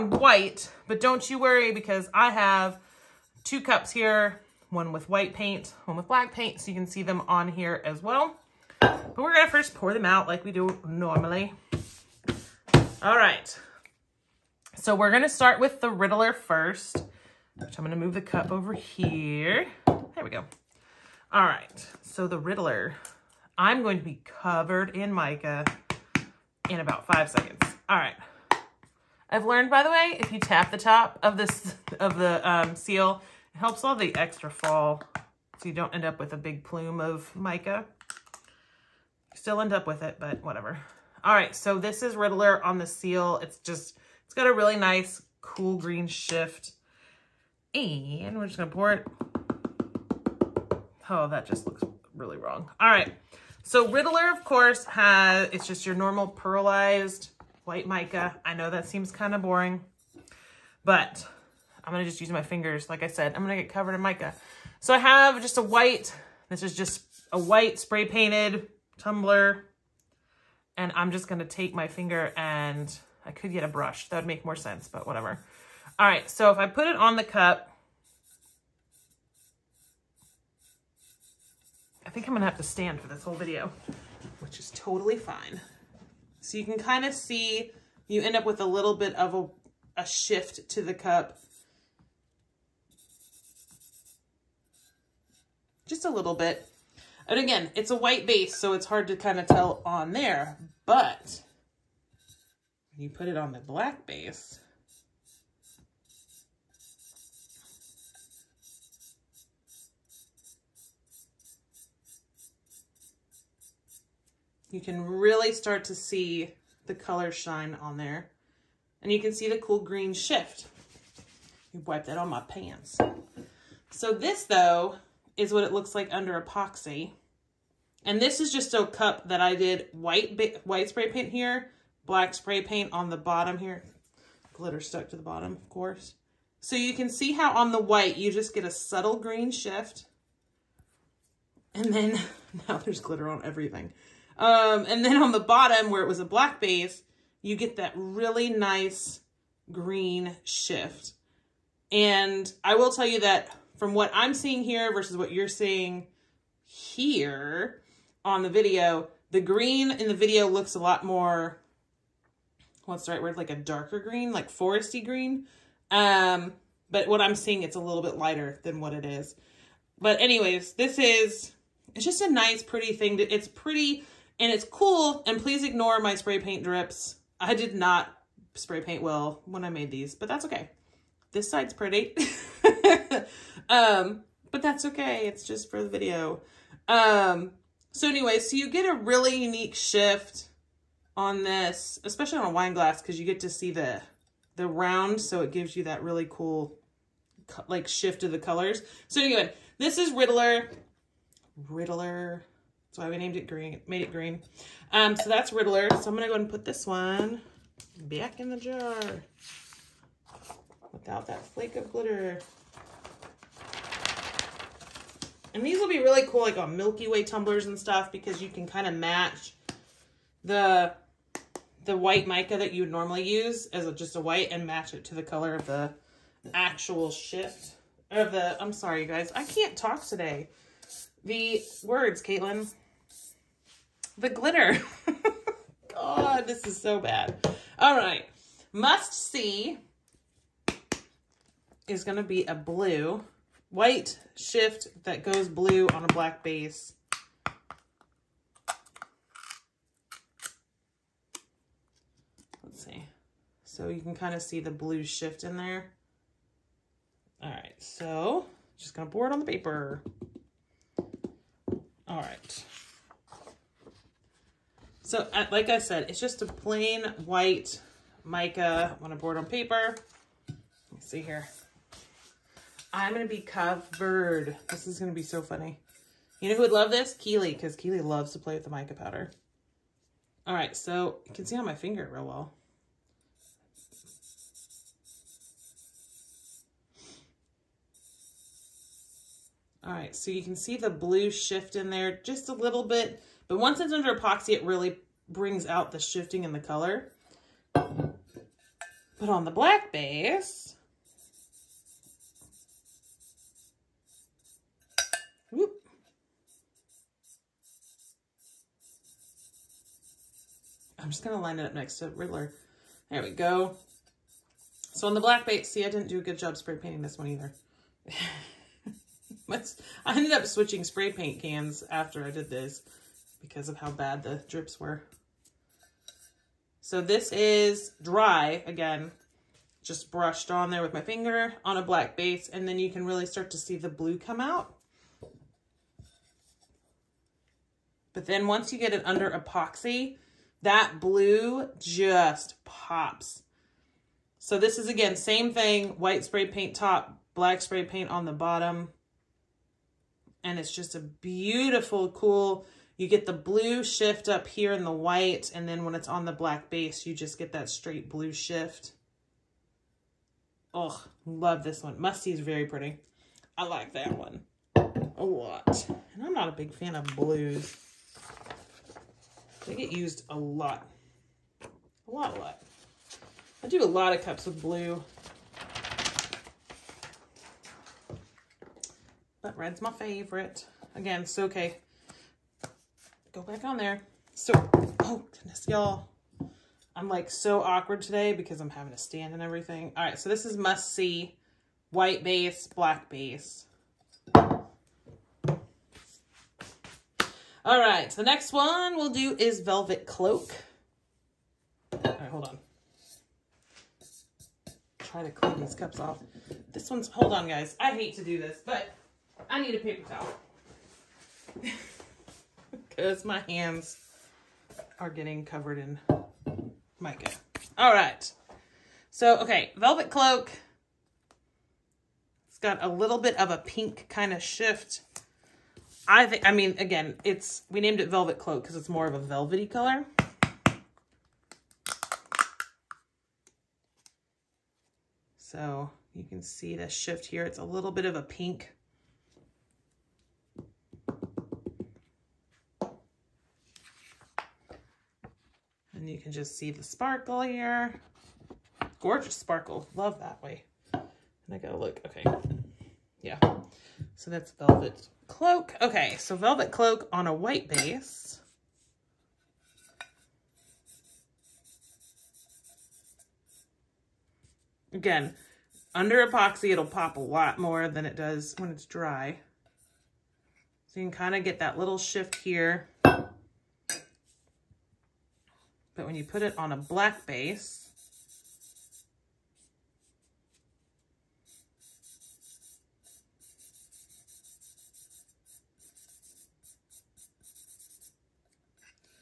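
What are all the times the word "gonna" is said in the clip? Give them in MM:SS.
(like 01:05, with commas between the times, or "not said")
00:48, 01:22, 03:26, 04:18.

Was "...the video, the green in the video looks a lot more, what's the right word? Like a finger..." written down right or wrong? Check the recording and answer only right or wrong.
wrong.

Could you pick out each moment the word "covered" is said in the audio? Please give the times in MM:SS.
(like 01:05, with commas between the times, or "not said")
00:24, 01:03, 04:33, 06:55.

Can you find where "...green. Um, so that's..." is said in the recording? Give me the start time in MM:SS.
03:24.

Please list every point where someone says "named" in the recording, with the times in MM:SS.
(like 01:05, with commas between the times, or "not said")
03:23, 07:07.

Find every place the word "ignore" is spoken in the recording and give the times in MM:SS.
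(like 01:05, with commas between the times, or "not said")
02:55.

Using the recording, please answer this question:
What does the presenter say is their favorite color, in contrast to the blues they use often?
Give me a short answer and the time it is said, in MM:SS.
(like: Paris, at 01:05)
Red, at 06:19.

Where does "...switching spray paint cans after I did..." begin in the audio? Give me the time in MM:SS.
05:20.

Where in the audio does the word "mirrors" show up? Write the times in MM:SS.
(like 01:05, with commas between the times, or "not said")
not said.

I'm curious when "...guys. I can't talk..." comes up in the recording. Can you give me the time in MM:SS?
03:49.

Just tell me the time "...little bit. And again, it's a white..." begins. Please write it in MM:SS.
01:36.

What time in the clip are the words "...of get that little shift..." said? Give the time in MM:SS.
07:51.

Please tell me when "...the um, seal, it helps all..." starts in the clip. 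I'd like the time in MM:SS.
00:32.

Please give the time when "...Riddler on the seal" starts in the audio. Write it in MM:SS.
00:42.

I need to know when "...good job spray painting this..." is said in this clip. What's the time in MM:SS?
05:16.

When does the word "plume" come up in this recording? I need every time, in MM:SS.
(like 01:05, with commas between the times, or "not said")
00:36.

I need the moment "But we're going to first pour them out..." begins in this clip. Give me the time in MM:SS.
00:08.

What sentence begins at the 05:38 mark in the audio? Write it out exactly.
But then once you get it under epoxy, that blue just pops.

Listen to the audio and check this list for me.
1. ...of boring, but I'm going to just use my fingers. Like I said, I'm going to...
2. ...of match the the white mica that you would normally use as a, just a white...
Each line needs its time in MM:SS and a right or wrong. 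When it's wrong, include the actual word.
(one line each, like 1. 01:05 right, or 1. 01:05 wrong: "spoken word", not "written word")
1. 00:59 right
2. 03:38 right.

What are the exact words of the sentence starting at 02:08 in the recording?
And this is just a cup that I did white white spray paint here, black spray paint on the bottom here.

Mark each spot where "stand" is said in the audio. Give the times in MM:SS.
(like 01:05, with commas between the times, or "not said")
01:22, 06:28.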